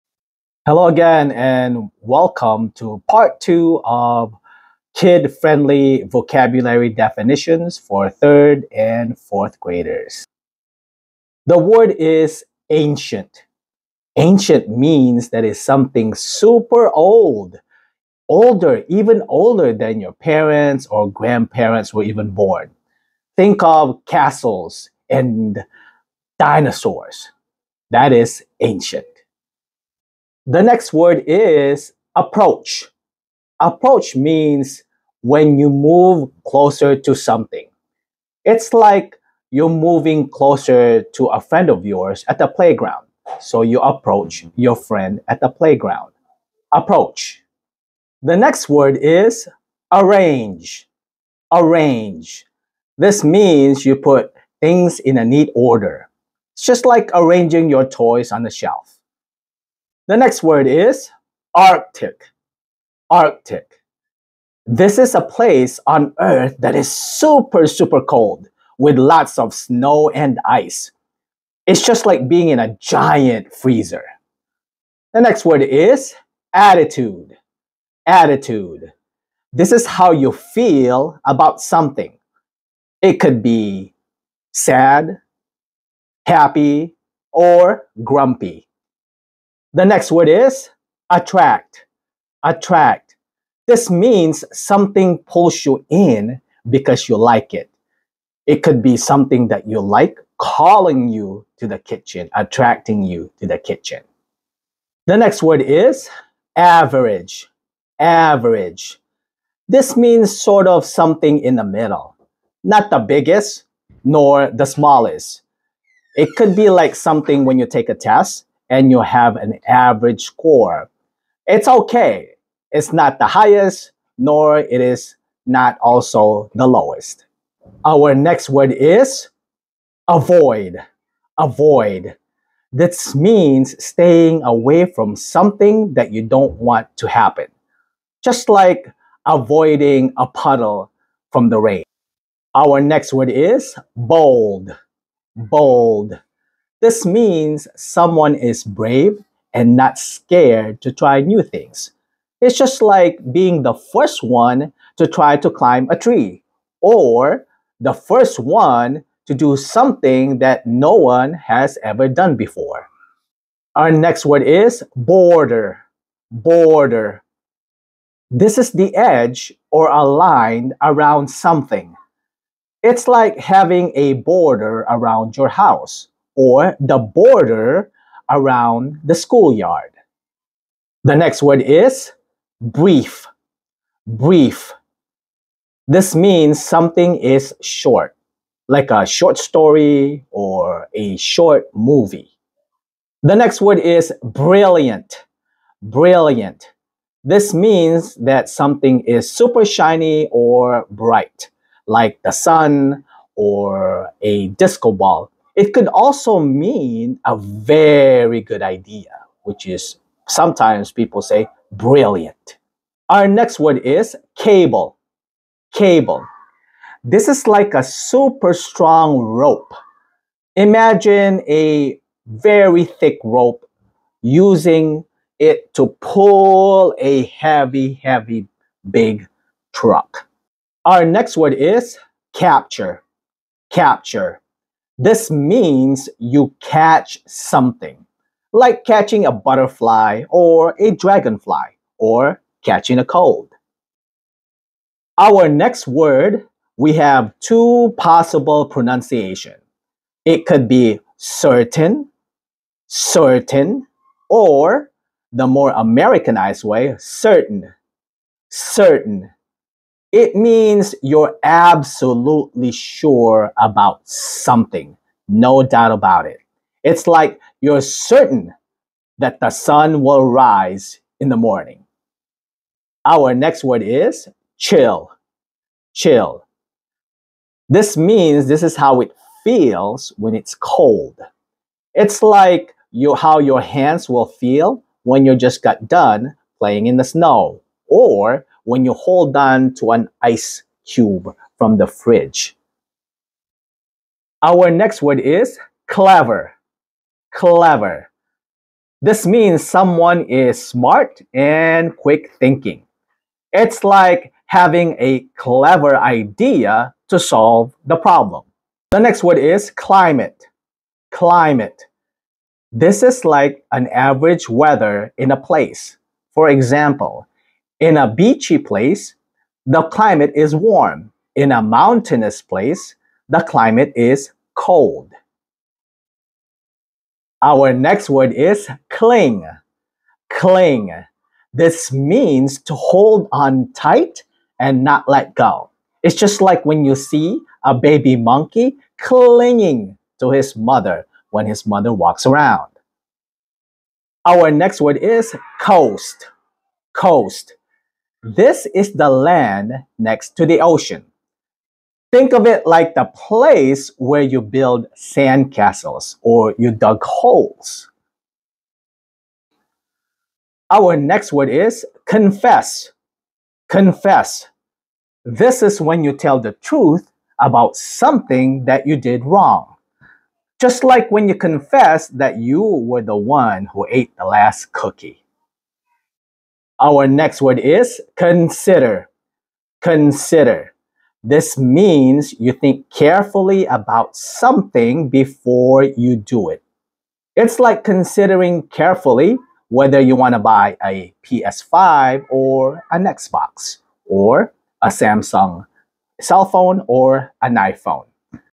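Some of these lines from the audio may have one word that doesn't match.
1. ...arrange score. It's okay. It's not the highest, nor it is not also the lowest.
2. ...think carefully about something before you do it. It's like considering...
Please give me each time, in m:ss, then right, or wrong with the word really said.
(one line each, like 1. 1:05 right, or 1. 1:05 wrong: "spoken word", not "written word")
1. 1:59 wrong: "average", not "arrange"
2. 6:22 right.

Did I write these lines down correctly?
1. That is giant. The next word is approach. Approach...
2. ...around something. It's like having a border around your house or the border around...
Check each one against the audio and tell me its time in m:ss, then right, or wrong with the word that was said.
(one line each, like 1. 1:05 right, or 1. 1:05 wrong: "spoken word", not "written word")
1. 0:27 wrong: "ancient", not "giant"
2. 2:50 right.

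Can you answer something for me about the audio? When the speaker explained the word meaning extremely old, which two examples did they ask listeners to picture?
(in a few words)
castles and dinosaurs.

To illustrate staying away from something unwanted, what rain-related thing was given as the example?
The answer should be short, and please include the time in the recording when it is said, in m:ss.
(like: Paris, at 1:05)
a puddle, at 2:20.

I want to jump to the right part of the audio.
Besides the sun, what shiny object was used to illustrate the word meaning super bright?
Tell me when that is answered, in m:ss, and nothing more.
3:24.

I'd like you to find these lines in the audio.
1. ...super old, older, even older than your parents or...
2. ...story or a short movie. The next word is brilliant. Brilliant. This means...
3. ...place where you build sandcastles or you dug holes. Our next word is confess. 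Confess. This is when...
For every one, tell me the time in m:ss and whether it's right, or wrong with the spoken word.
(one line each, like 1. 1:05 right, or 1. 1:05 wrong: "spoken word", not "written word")
1. 0:16 right
2. 3:09 right
3. 5:53 right.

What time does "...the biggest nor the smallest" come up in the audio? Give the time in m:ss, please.
1:52.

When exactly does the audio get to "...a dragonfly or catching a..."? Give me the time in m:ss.
4:00.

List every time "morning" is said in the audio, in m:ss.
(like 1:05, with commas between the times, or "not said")
4:31.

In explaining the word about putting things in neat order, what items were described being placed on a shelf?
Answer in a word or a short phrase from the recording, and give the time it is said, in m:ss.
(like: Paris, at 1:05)
toys, at 0:57.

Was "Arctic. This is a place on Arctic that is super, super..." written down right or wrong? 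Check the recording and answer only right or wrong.
wrong.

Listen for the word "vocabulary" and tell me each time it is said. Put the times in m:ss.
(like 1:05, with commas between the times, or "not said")
0:06.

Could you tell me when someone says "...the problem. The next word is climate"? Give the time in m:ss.
5:07.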